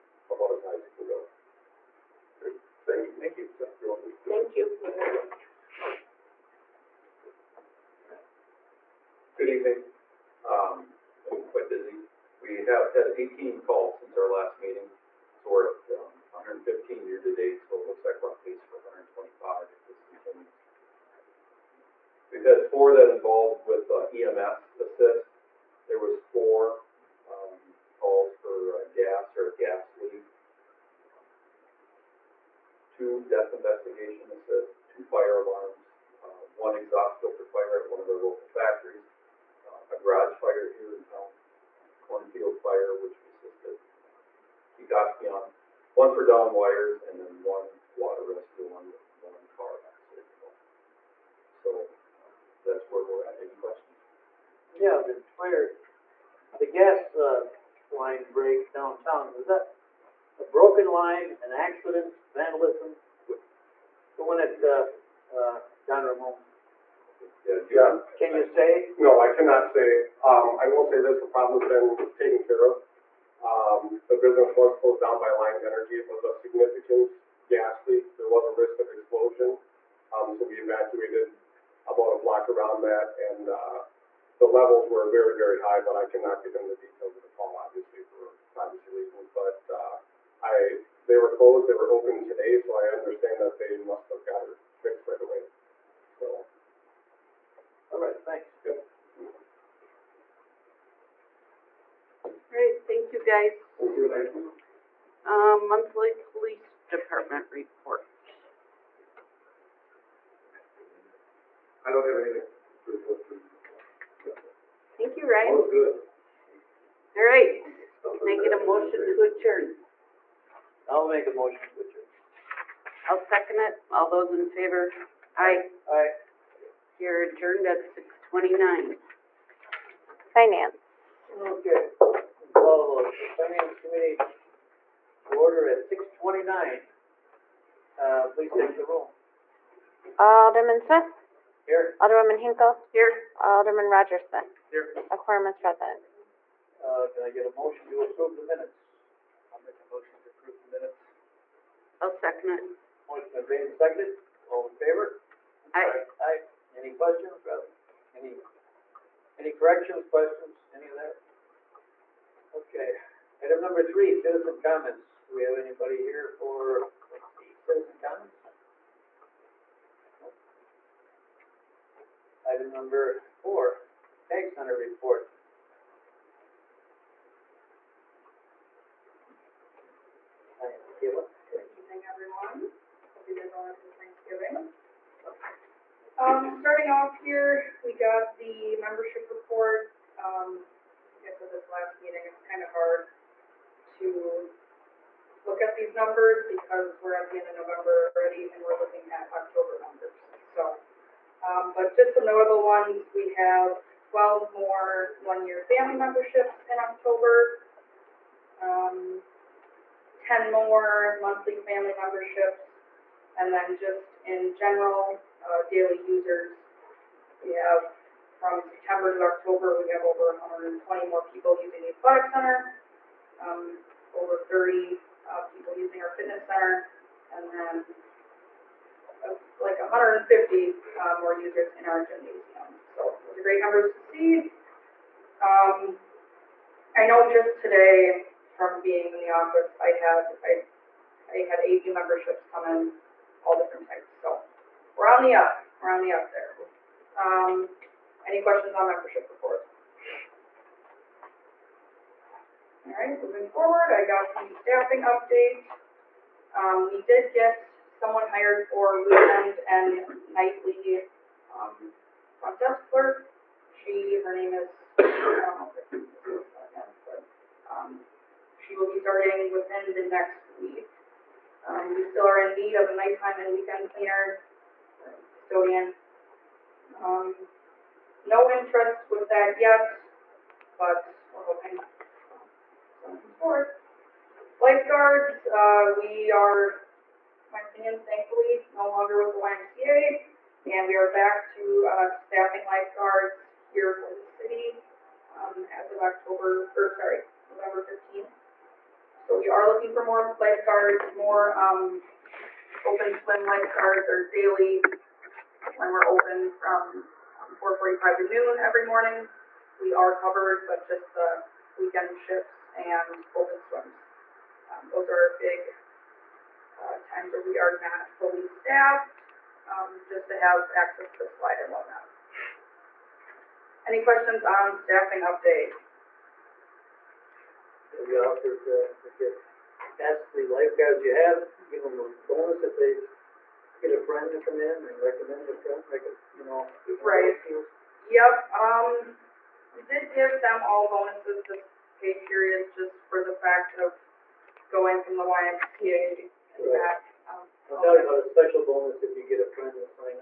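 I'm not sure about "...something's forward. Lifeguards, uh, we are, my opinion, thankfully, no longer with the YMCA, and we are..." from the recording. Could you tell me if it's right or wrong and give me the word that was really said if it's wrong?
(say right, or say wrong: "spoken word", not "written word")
right.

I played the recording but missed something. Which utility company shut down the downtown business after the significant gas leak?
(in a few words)
Alliant Energy.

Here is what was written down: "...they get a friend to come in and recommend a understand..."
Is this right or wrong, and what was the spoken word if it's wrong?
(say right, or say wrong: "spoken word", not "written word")
wrong: "friend", not "understand".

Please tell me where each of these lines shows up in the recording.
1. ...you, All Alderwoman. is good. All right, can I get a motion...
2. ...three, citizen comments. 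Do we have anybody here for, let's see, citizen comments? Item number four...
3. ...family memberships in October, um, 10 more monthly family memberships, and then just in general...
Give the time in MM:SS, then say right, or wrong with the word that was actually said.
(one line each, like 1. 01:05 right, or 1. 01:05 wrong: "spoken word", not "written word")
1. 01:55 wrong: "Ryan", not "Alderwoman"
2. 02:43 right
3. 03:25 right.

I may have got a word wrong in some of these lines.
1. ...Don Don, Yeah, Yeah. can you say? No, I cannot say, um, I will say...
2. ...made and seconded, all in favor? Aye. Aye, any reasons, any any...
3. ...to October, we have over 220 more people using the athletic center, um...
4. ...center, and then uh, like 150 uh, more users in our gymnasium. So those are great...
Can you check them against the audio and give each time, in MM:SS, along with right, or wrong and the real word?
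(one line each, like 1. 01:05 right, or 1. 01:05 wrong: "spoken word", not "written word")
1. 01:05 wrong: "Ramon", not "Don"
2. 02:33 wrong: "questions", not "reasons"
3. 03:39 wrong: "120", not "220"
4. 03:46 right.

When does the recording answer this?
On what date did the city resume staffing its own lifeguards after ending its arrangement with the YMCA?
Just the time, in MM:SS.
04:57.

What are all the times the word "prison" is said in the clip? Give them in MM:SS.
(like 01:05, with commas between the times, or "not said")
not said.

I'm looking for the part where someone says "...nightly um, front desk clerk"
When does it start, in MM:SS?
04:20.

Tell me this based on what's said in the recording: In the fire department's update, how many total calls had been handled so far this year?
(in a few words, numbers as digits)
115.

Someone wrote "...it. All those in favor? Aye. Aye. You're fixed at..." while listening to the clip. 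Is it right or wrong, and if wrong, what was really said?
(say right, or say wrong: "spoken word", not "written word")
wrong: "adjourned", not "fixed".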